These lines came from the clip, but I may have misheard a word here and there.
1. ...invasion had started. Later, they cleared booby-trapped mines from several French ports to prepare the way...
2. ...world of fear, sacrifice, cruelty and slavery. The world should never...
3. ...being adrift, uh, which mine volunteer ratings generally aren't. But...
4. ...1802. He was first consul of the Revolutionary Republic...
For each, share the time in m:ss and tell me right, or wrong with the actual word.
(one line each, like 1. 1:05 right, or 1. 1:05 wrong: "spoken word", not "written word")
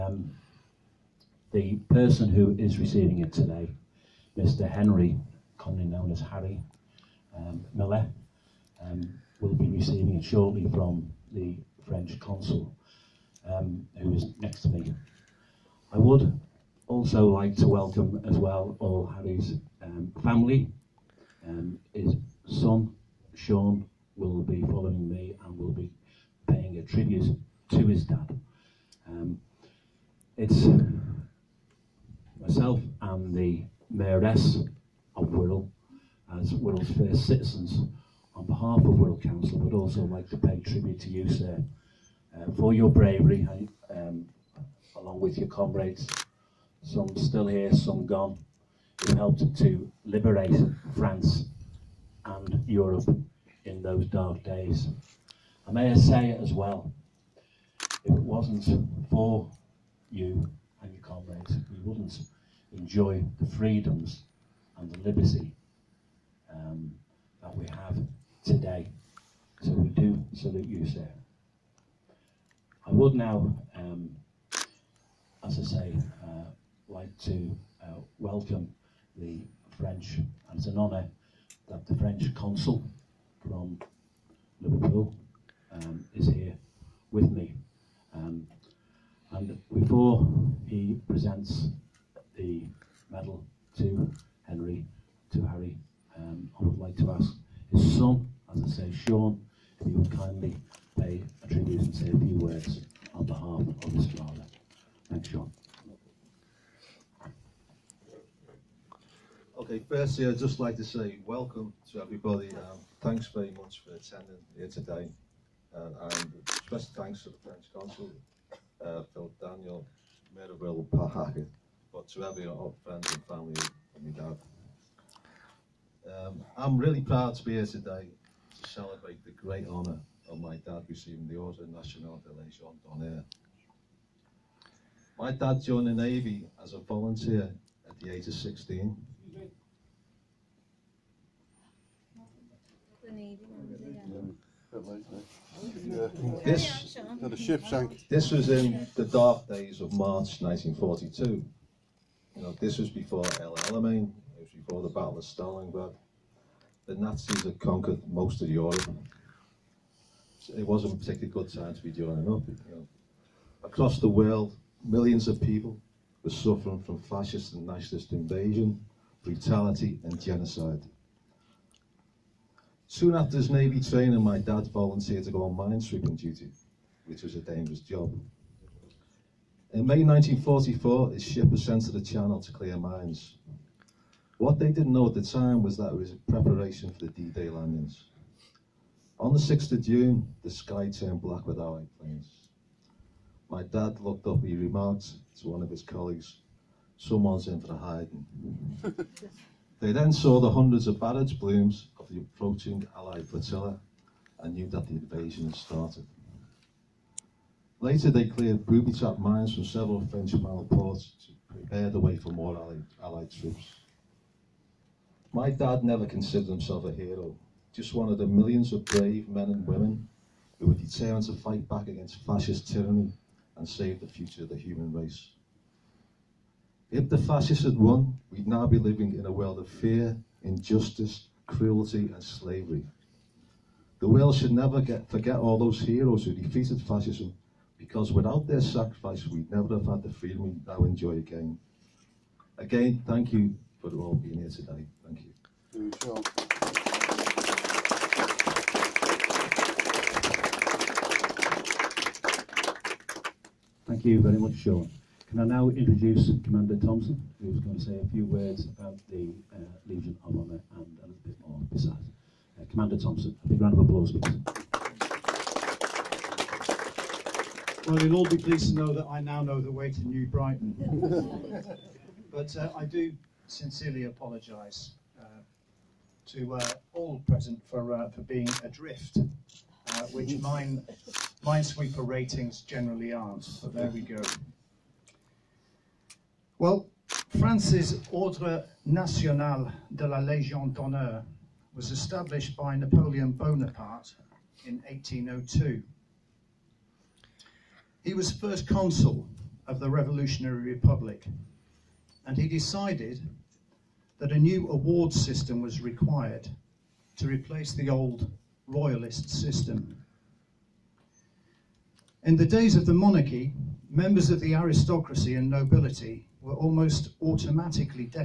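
1. 3:24 right
2. 3:49 wrong: "injustice", not "sacrifice"
3. 4:38 wrong: "minesweeper", not "volunteer"
4. 4:54 right.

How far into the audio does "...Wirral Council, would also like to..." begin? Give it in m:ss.
0:38.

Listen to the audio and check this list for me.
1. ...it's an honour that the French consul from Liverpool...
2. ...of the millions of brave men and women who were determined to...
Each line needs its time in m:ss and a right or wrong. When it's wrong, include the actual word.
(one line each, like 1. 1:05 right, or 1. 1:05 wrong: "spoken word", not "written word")
1. 1:20 right
2. 3:38 right.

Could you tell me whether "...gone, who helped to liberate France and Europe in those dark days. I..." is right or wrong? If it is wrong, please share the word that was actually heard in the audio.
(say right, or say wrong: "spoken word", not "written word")
right.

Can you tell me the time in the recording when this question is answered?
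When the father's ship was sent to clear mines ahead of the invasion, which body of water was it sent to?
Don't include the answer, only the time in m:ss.
3:01.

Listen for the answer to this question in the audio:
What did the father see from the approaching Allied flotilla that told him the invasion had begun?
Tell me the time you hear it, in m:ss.
3:20.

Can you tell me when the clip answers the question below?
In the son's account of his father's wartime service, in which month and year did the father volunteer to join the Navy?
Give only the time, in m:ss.
2:29.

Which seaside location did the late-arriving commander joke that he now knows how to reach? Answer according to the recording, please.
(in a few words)
New Brighton.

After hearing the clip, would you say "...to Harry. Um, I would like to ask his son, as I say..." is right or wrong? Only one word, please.
right.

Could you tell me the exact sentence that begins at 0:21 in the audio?
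Um, his son, Sean, will be following me and will be paying a tribute to his dad.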